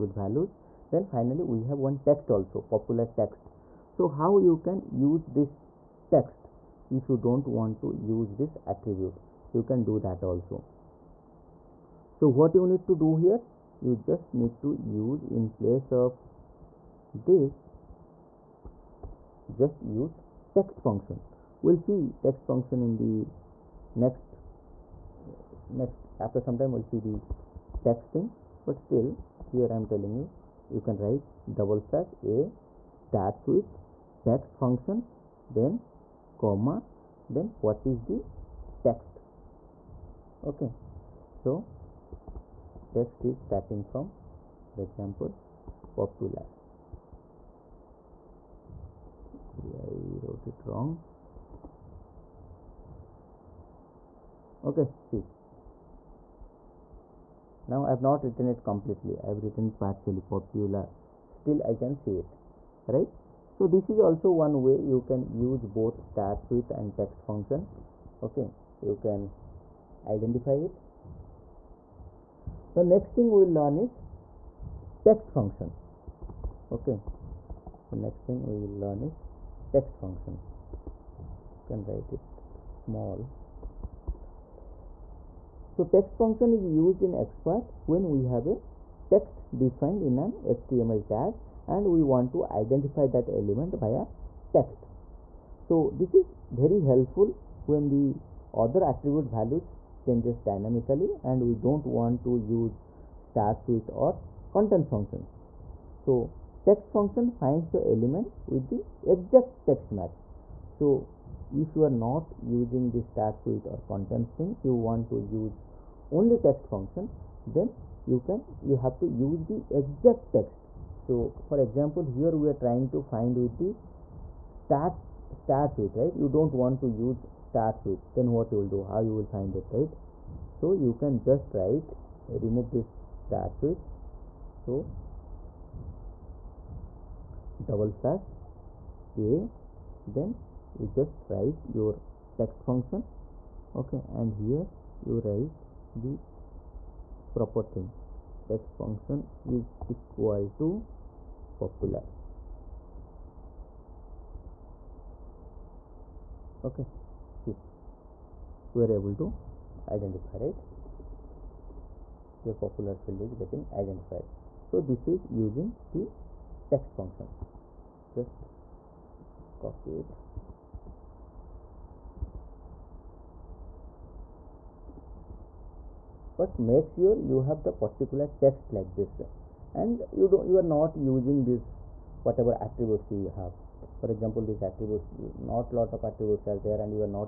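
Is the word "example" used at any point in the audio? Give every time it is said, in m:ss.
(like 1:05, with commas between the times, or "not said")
0:44, 2:01, 3:04.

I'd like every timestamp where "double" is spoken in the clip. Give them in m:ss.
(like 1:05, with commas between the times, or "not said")
0:31, 2:17.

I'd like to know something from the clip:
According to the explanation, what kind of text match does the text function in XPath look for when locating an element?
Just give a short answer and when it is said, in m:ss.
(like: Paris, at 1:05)
exact text match, at 1:49.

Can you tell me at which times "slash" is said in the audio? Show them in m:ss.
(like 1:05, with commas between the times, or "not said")
0:31, 2:18.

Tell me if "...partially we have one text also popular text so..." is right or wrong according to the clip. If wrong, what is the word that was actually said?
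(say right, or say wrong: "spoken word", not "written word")
wrong: "finally", not "partially".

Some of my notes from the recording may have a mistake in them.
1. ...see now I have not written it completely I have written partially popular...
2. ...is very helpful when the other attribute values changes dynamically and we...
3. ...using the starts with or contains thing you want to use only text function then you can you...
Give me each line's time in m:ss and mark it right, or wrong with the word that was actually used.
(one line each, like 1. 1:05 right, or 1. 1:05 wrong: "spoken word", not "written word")
1. 0:55 right
2. 1:36 right
3. 1:52 right.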